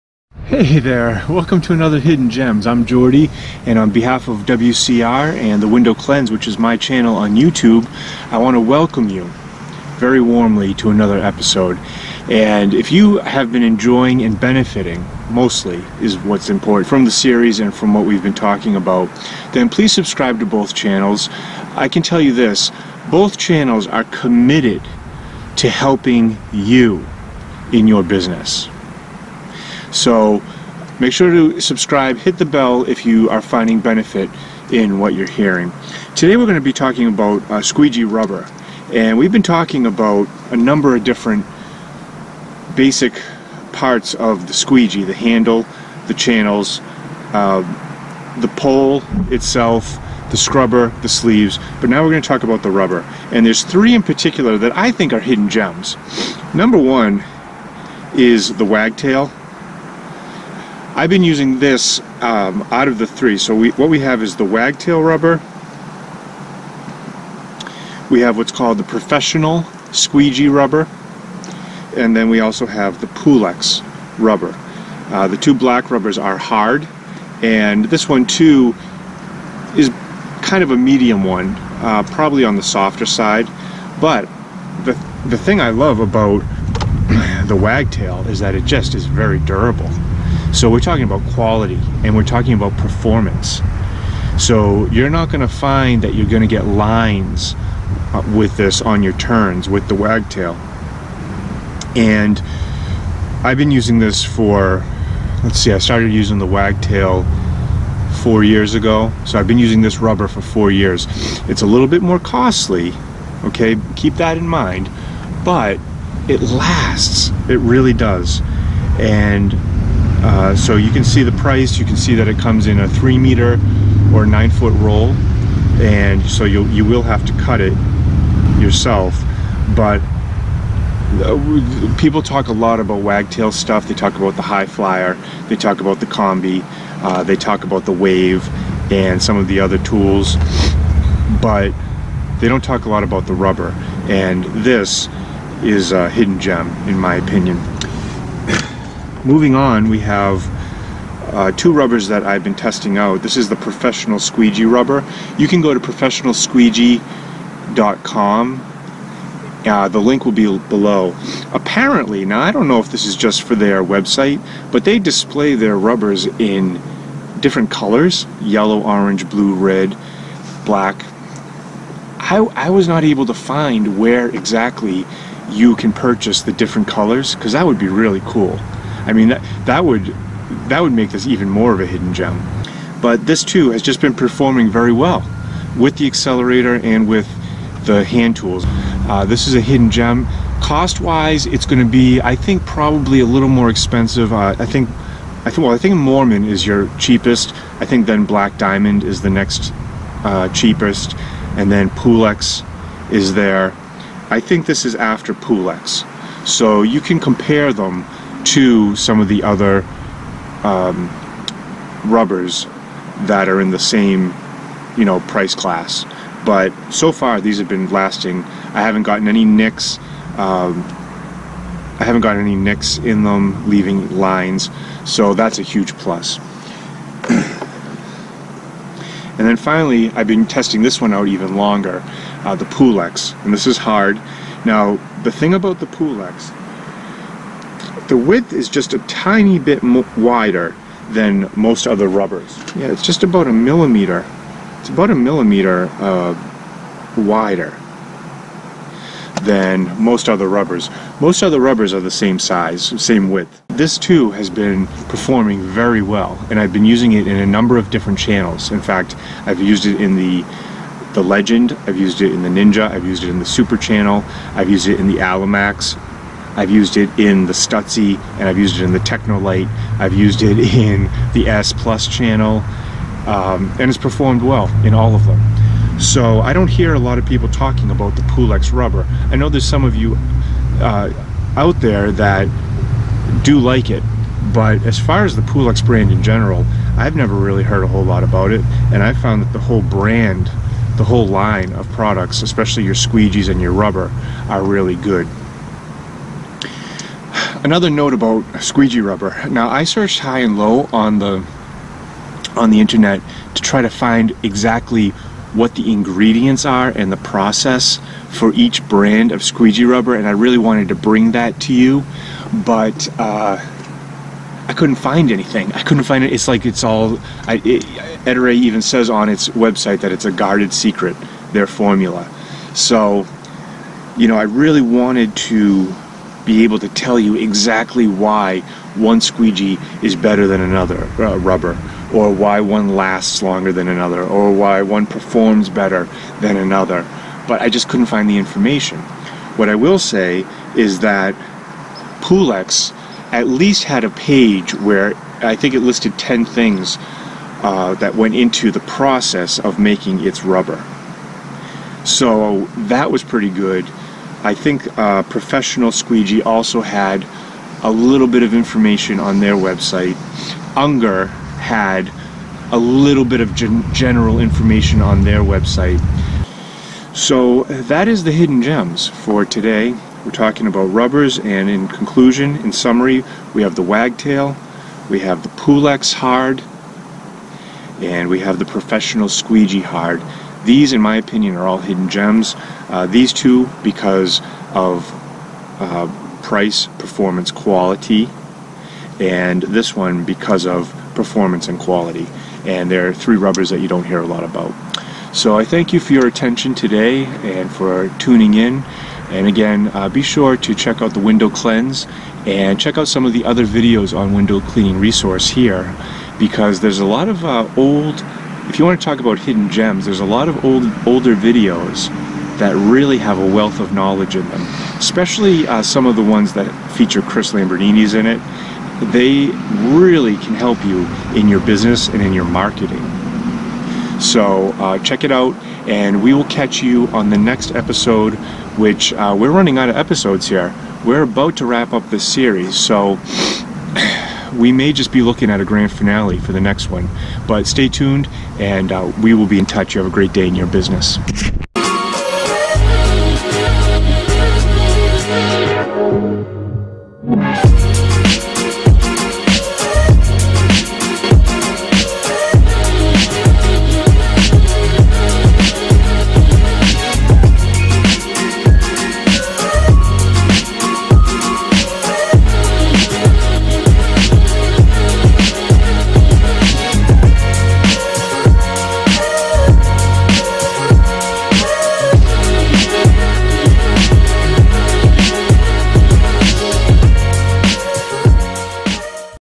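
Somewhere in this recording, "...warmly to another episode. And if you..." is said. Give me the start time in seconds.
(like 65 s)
10 s.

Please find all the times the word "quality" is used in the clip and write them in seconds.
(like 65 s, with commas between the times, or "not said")
91 s, 387 s, 391 s.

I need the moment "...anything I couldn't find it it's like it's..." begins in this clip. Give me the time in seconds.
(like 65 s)
315 s.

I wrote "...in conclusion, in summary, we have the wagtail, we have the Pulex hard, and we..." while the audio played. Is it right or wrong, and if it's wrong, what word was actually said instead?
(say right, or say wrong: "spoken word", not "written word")
right.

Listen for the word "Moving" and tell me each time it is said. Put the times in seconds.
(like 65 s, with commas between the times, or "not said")
149 s.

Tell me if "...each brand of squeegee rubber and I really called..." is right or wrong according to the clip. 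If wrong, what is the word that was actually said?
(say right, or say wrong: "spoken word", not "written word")
wrong: "wanted", not "called".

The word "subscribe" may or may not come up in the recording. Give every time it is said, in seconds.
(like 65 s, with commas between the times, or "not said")
19 s, 31 s.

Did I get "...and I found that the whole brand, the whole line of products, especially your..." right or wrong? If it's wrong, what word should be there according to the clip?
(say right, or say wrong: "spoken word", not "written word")
right.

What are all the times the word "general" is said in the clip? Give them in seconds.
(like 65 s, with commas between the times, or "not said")
286 s, 363 s.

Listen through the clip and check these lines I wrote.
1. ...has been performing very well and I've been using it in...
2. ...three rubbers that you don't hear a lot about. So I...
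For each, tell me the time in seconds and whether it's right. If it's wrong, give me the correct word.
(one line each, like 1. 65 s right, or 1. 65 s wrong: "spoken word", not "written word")
1. 254 s right
2. 393 s right.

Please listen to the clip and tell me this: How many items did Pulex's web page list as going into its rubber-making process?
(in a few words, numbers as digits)
10.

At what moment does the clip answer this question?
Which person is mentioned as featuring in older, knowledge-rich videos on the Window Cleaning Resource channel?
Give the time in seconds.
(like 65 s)
417 s.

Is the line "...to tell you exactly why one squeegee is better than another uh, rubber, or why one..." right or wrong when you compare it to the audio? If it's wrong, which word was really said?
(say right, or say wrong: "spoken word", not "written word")
right.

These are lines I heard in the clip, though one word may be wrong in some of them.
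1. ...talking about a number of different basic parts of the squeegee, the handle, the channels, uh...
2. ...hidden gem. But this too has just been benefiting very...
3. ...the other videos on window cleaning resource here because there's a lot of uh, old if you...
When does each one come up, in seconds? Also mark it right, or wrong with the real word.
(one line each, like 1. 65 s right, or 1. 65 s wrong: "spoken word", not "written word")
1. 39 s right
2. 181 s wrong: "performing", not "benefiting"
3. 403 s right.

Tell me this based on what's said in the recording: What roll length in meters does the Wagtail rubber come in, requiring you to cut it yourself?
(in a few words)
3 meters.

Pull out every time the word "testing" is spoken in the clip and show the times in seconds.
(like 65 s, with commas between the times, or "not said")
152 s, 230 s.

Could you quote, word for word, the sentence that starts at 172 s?
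I, I was not able to find where exactly you can purchase the different colors because that would be really cool.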